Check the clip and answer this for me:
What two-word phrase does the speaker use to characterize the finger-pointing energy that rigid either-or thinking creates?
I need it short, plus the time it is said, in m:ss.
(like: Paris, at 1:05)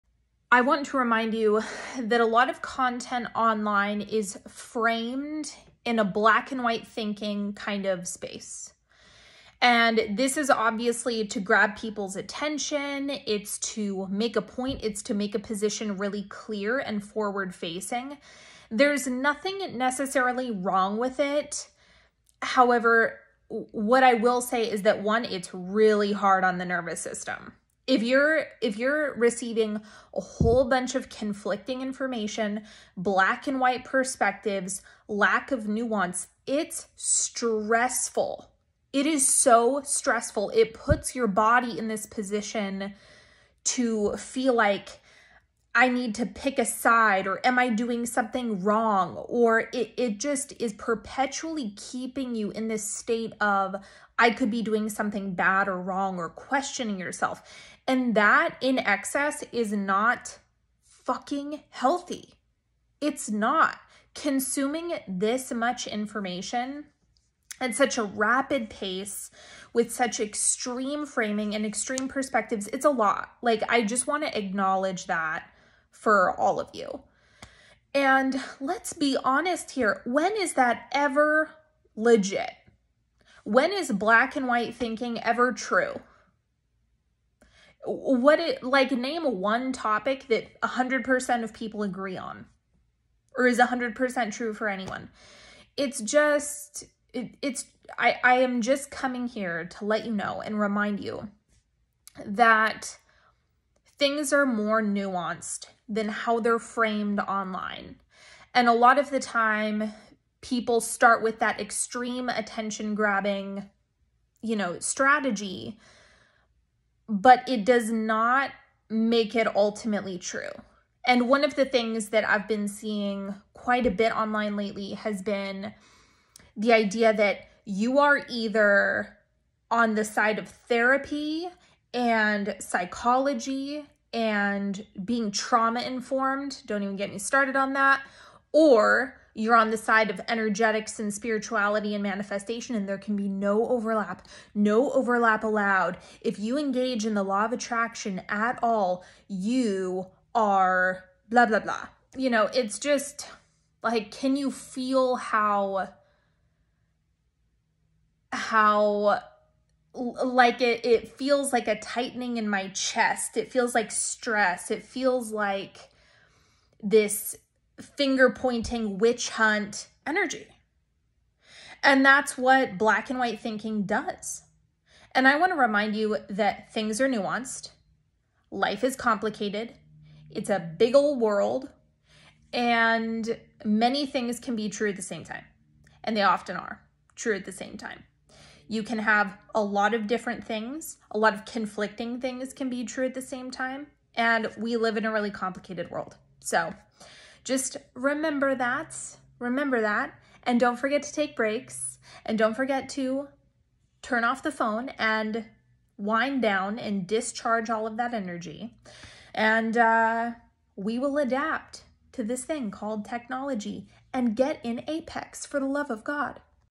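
Witch hunt, at 2:48.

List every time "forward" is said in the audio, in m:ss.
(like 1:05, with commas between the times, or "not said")
0:17.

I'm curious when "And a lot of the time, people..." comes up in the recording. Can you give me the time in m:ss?
1:48.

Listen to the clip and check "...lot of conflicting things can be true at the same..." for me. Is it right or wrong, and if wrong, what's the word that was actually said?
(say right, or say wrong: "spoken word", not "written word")
right.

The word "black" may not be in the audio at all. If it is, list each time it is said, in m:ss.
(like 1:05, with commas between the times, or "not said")
0:06, 0:32, 1:23, 2:52.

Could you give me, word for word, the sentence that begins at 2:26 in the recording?
If you engage in the law of attraction at all, you are blah, blah, blah.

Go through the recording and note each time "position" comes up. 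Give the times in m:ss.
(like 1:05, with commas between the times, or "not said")
0:15, 0:42.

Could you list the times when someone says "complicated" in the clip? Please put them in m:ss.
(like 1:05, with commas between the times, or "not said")
2:58, 3:15.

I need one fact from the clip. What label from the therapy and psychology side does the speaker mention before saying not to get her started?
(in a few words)
Trauma informed.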